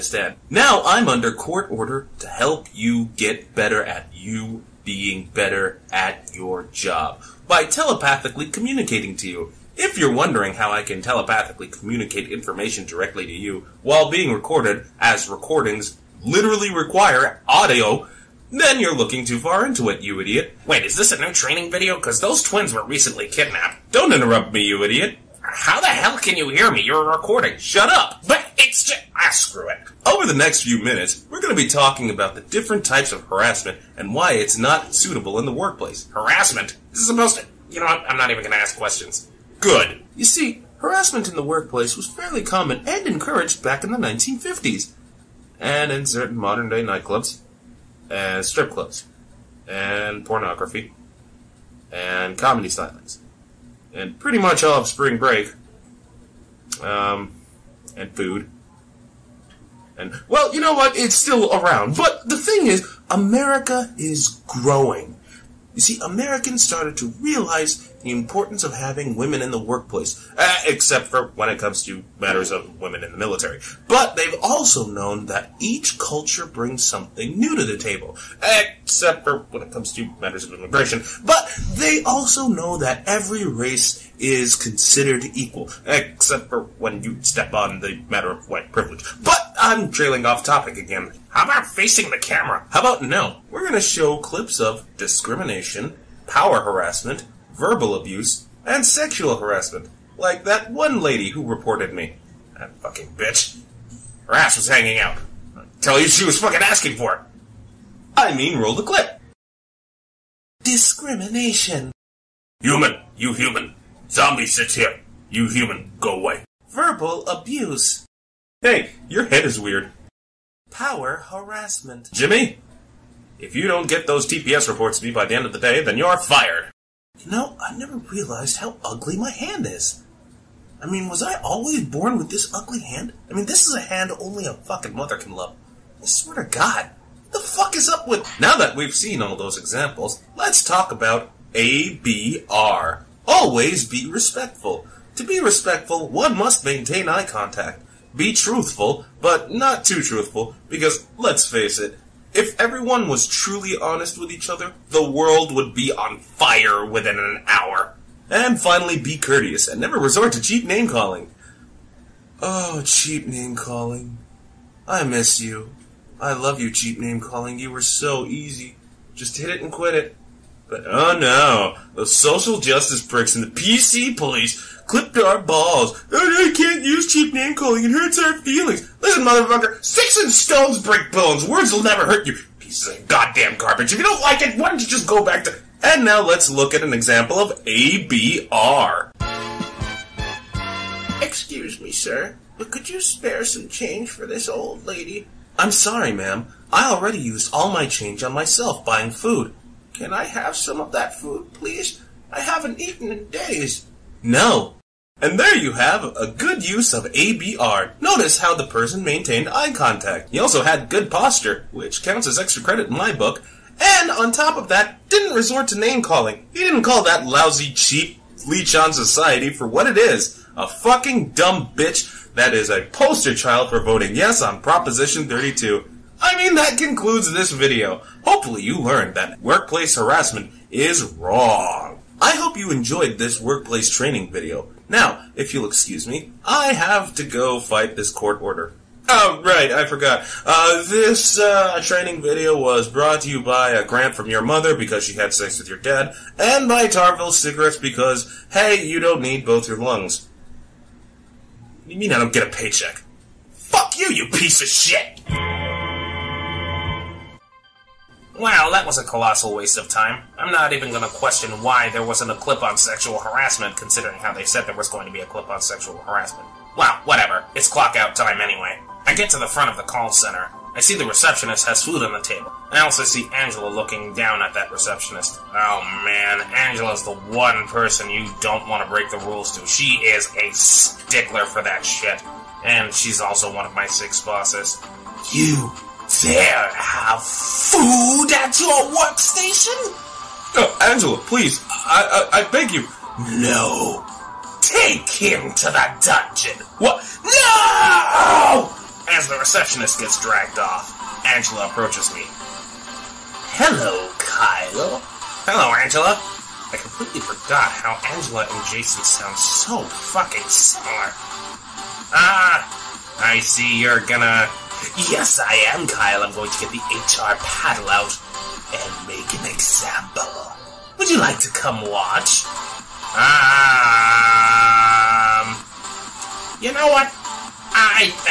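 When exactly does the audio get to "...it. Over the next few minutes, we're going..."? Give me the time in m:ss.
0:29.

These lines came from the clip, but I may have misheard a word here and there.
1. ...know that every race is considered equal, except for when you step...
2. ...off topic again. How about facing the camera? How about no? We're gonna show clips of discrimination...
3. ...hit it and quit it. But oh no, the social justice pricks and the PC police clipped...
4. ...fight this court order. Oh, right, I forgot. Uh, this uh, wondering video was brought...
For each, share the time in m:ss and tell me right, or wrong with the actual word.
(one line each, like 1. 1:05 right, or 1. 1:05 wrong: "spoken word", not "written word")
1. 1:22 right
2. 1:30 right
3. 2:49 right
4. 3:57 wrong: "training", not "wondering".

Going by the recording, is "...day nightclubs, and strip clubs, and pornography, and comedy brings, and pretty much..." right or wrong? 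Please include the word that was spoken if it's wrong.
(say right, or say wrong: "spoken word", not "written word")
wrong: "stylings", not "brings".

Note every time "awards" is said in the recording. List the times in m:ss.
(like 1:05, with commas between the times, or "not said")
not said.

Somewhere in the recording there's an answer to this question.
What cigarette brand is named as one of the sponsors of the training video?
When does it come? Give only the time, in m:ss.
4:06.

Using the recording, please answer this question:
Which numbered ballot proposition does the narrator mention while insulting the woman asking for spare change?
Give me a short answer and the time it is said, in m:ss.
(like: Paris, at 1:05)
Proposition 32, at 3:44.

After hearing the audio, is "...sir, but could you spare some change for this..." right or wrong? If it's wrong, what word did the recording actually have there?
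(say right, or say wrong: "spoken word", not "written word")
right.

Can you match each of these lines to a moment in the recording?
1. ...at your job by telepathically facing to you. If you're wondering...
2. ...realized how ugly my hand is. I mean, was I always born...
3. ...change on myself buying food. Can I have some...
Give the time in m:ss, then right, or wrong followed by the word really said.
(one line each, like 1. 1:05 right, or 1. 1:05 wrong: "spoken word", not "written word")
1. 0:05 wrong: "communicating", not "facing"
2. 2:07 right
3. 3:17 right.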